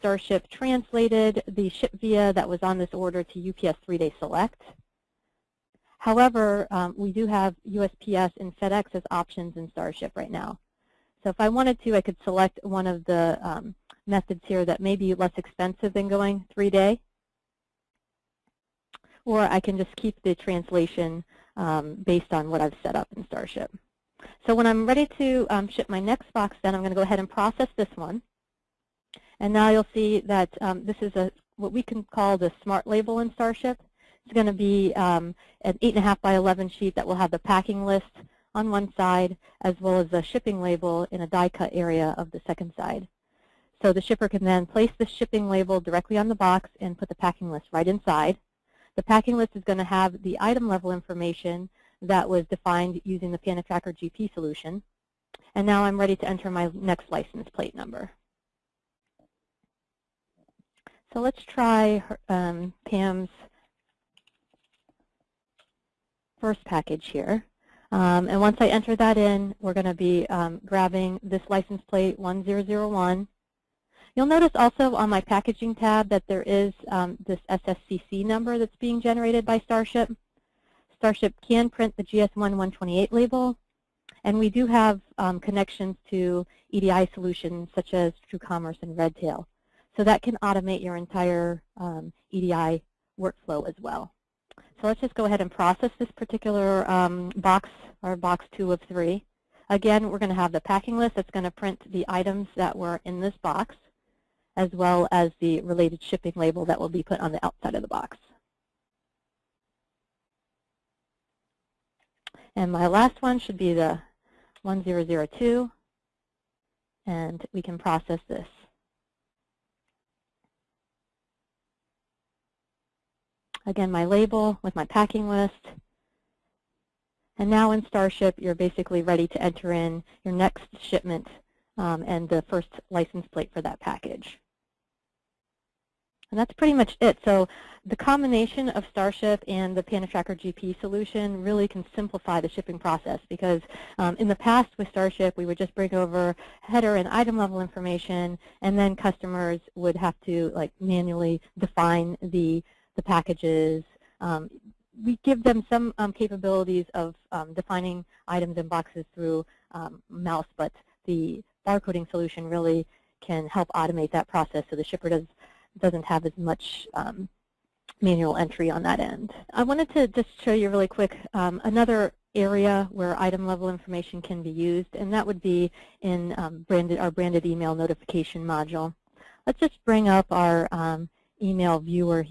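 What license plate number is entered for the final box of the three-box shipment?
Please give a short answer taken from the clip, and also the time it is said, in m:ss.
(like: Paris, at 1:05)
1002, at 1:54.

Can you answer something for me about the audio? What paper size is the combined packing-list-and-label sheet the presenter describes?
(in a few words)
8.5 by 11.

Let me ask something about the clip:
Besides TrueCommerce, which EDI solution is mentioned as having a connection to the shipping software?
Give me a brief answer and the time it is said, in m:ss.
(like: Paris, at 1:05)
Redtail, at 1:28.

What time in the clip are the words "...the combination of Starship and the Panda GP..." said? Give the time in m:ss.
2:17.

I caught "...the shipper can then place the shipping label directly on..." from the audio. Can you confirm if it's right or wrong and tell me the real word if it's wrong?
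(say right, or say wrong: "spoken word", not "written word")
right.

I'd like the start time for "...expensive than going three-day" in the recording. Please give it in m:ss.
0:15.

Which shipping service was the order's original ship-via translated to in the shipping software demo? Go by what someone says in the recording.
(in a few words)
UPS three-day select.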